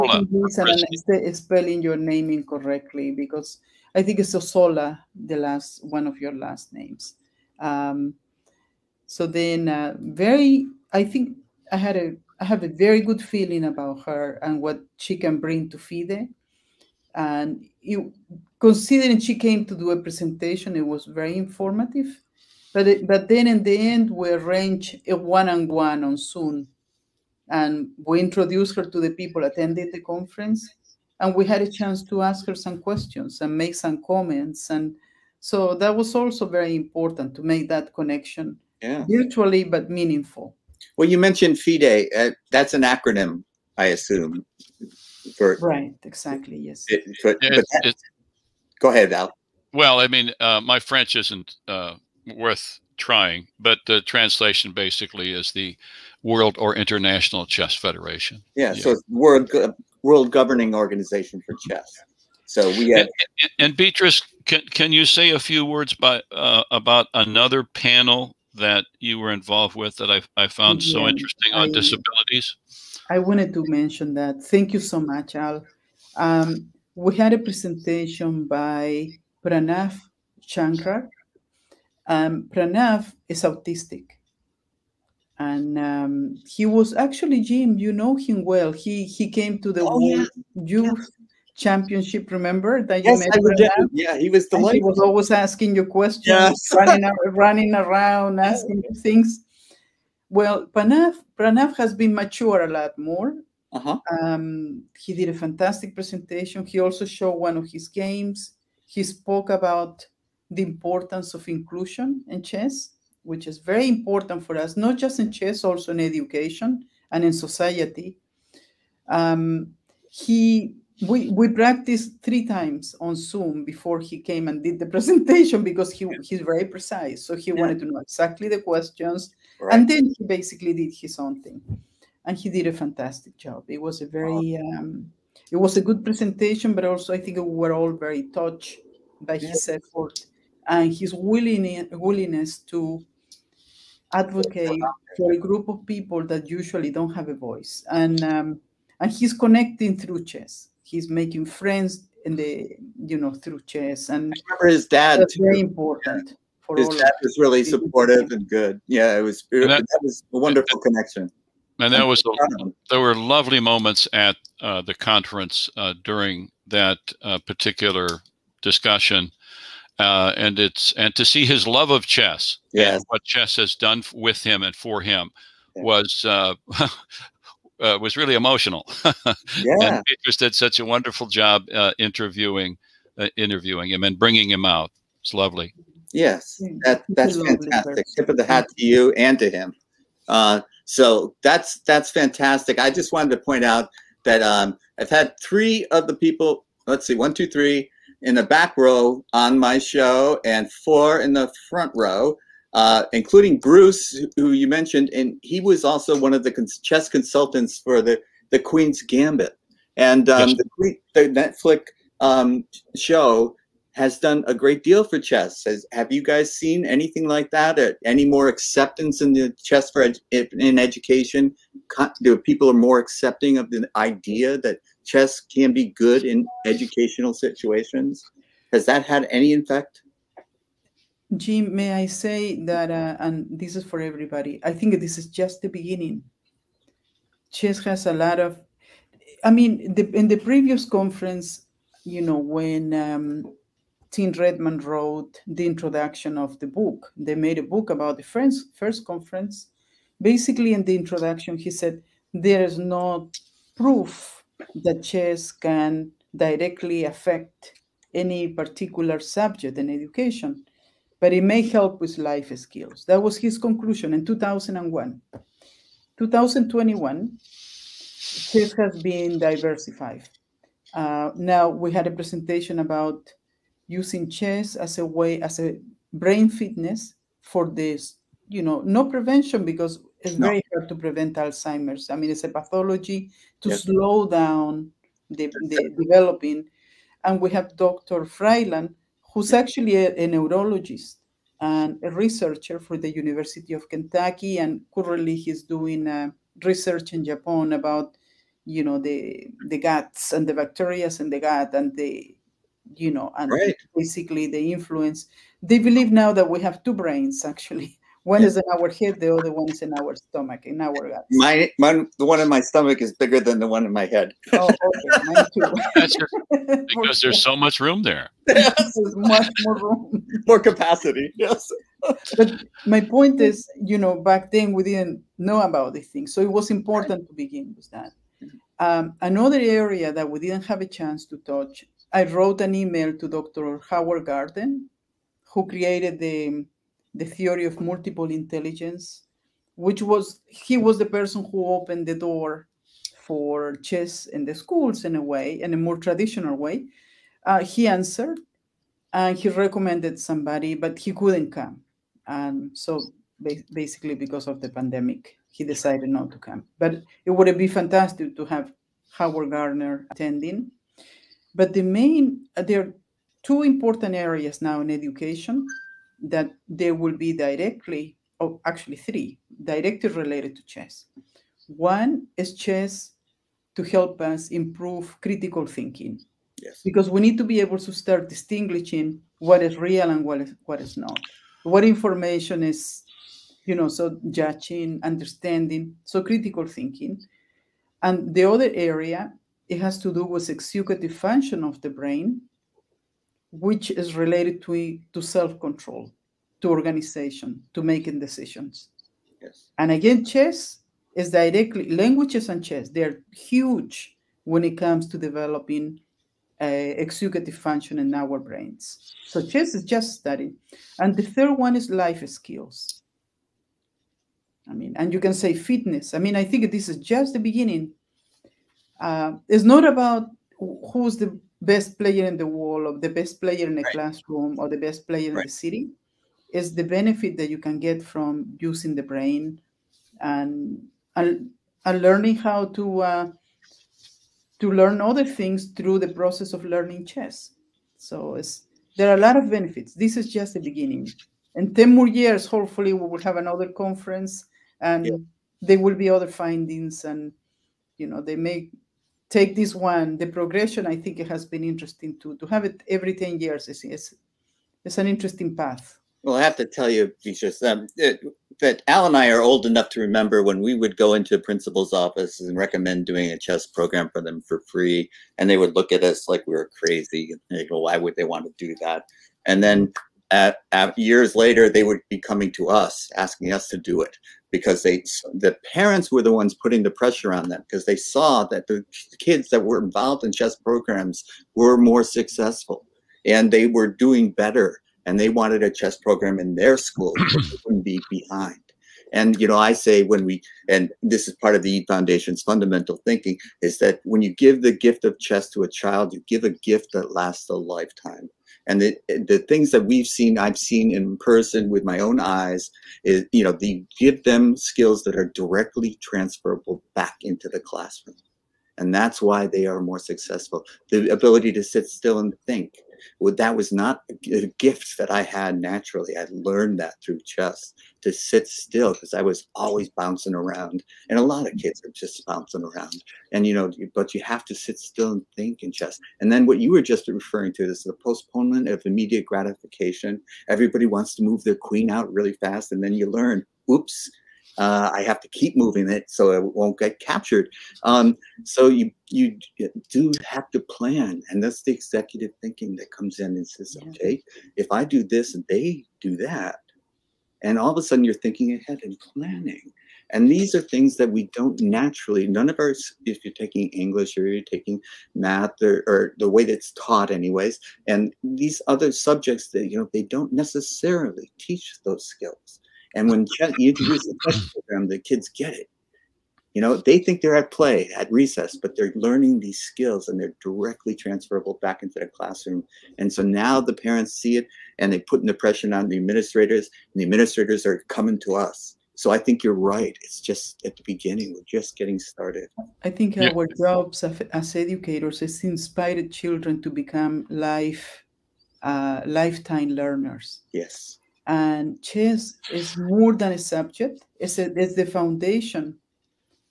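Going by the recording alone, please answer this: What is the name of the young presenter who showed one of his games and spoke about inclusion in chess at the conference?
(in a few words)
Pranav Chankar.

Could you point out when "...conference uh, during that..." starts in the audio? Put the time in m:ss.
2:44.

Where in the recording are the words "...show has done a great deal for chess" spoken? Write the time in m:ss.
3:32.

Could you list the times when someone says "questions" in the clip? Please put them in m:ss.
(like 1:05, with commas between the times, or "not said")
0:32, 1:35, 2:08.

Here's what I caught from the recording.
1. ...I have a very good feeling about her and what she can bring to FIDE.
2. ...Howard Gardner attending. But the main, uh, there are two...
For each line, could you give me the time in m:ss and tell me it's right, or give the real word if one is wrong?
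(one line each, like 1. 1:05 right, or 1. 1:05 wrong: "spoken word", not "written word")
1. 0:12 right
2. 5:59 right.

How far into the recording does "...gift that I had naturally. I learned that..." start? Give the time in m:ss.
8:34.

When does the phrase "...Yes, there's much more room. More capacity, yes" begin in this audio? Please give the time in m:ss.
5:18.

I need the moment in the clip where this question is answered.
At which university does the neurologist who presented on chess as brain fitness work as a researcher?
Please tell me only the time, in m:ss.
4:53.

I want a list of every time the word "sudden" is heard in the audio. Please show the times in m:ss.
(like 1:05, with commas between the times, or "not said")
9:07.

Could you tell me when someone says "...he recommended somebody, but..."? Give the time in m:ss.
5:49.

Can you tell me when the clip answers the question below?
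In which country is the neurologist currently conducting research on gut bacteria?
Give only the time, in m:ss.
4:57.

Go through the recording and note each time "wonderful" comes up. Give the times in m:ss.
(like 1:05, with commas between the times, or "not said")
2:40, 3:00.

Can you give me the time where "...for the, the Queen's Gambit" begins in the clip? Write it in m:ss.
3:27.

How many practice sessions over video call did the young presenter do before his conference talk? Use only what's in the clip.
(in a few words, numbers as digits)
3 times.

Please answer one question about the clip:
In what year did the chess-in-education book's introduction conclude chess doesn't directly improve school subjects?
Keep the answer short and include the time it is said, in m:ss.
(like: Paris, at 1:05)
2001, at 4:24.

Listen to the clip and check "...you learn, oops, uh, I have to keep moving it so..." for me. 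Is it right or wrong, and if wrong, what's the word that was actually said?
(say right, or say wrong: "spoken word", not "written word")
right.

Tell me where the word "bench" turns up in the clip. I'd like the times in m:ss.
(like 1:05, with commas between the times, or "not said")
not said.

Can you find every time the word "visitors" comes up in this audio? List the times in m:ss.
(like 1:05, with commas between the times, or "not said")
not said.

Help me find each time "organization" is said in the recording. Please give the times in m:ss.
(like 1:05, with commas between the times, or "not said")
1:00, 6:36.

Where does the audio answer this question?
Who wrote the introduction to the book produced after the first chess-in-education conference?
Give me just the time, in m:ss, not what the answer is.
4:04.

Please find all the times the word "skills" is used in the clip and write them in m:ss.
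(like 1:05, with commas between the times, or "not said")
4:22, 6:52, 8:24, 9:22, 9:29.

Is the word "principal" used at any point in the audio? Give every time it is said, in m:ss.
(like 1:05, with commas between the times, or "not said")
7:41.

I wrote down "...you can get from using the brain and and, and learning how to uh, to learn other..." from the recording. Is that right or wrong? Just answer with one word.
right.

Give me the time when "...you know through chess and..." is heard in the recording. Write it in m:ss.
2:33.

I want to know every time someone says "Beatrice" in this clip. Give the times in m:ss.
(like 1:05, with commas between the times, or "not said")
1:03, 3:00.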